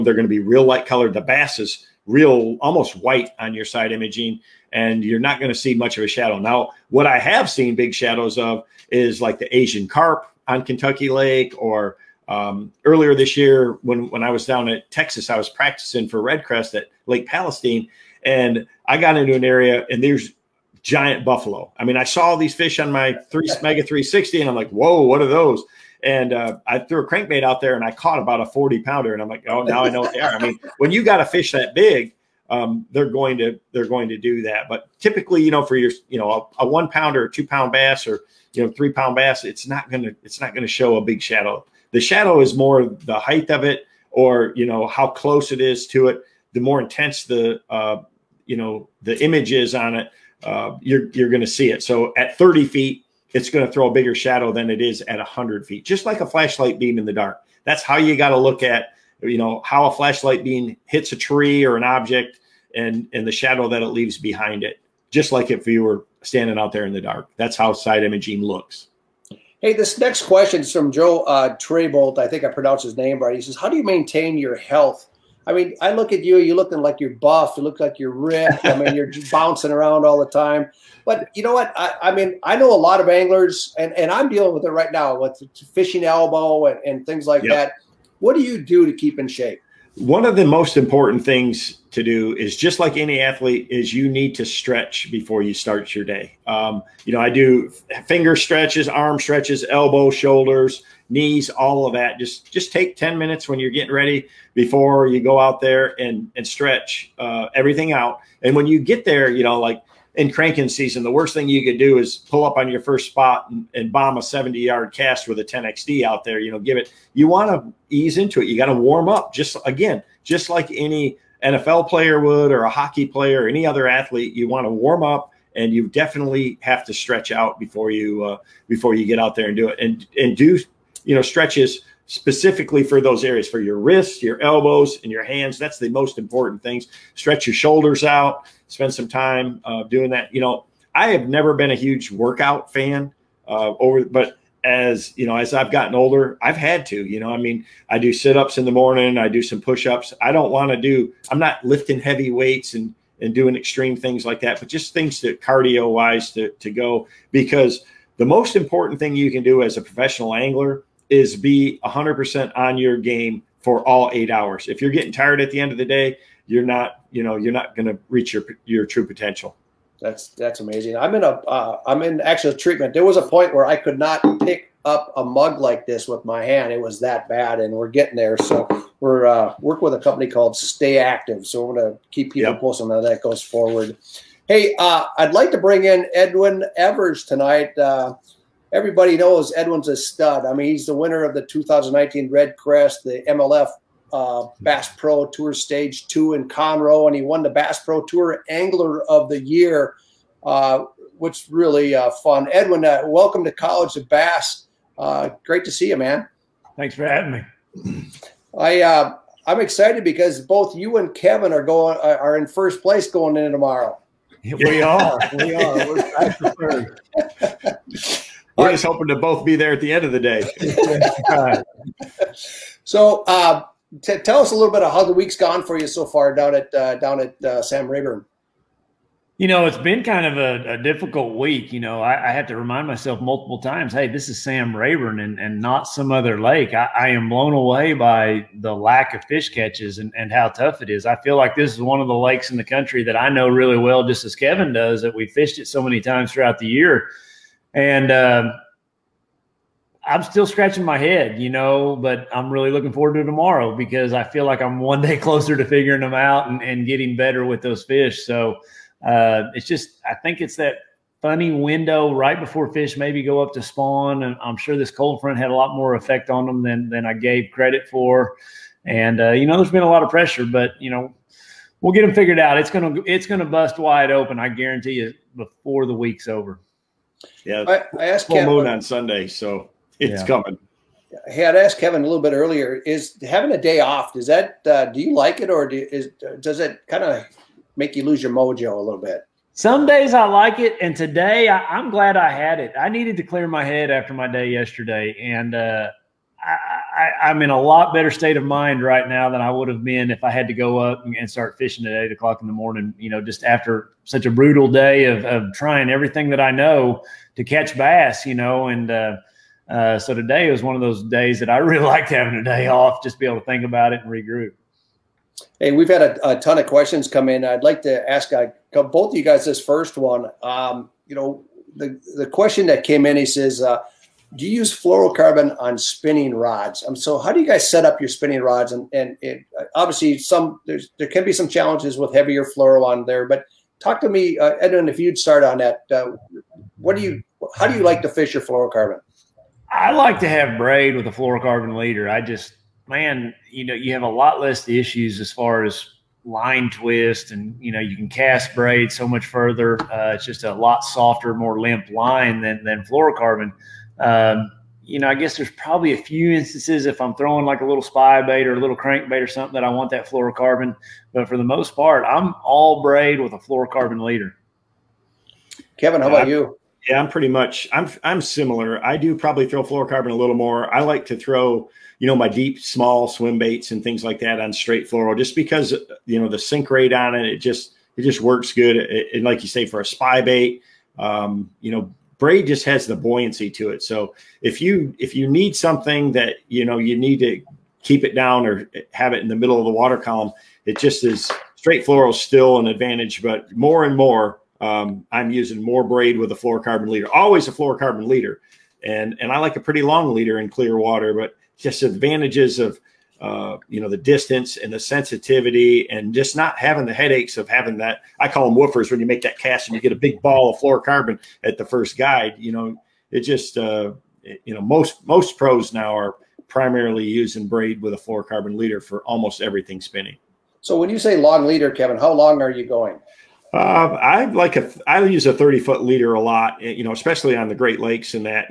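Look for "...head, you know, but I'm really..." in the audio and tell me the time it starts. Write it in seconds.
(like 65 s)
250 s.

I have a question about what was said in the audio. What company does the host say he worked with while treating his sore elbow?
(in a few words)
Stay Active.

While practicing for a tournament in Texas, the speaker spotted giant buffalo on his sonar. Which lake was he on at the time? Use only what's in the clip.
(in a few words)
Lake Palestine.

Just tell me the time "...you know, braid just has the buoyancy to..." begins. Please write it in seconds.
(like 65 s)
381 s.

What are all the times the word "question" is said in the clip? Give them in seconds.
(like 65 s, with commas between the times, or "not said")
70 s, 316 s, 322 s.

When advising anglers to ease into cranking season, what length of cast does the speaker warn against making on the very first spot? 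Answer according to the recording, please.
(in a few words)
70 yards.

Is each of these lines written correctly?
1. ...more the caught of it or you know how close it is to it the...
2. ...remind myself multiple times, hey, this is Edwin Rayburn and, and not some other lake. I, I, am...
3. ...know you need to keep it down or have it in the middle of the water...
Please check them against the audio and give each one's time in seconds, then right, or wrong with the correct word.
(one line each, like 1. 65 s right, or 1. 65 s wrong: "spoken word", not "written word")
1. 42 s wrong: "height", not "caught"
2. 232 s wrong: "Sam", not "Edwin"
3. 386 s right.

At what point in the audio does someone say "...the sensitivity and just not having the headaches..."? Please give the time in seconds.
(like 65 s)
404 s.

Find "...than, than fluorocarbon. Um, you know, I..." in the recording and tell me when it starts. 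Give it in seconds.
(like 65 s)
352 s.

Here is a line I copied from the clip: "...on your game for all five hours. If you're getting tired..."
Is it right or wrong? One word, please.
wrong.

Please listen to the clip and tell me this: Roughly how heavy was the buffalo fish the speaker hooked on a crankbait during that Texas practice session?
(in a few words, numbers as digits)
40 pounds.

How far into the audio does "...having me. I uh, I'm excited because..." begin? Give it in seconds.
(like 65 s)
207 s.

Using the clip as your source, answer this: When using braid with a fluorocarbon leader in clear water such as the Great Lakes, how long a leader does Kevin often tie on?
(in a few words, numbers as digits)
30 feet.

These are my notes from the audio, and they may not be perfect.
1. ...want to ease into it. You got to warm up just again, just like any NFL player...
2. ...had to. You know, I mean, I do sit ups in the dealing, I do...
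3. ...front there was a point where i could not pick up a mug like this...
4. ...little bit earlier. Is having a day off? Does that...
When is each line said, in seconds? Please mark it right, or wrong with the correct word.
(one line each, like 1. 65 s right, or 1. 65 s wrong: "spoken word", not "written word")
1. 117 s right
2. 146 s wrong: "morning", not "dealing"
3. 172 s wrong: "treatment", not "front"
4. 282 s right.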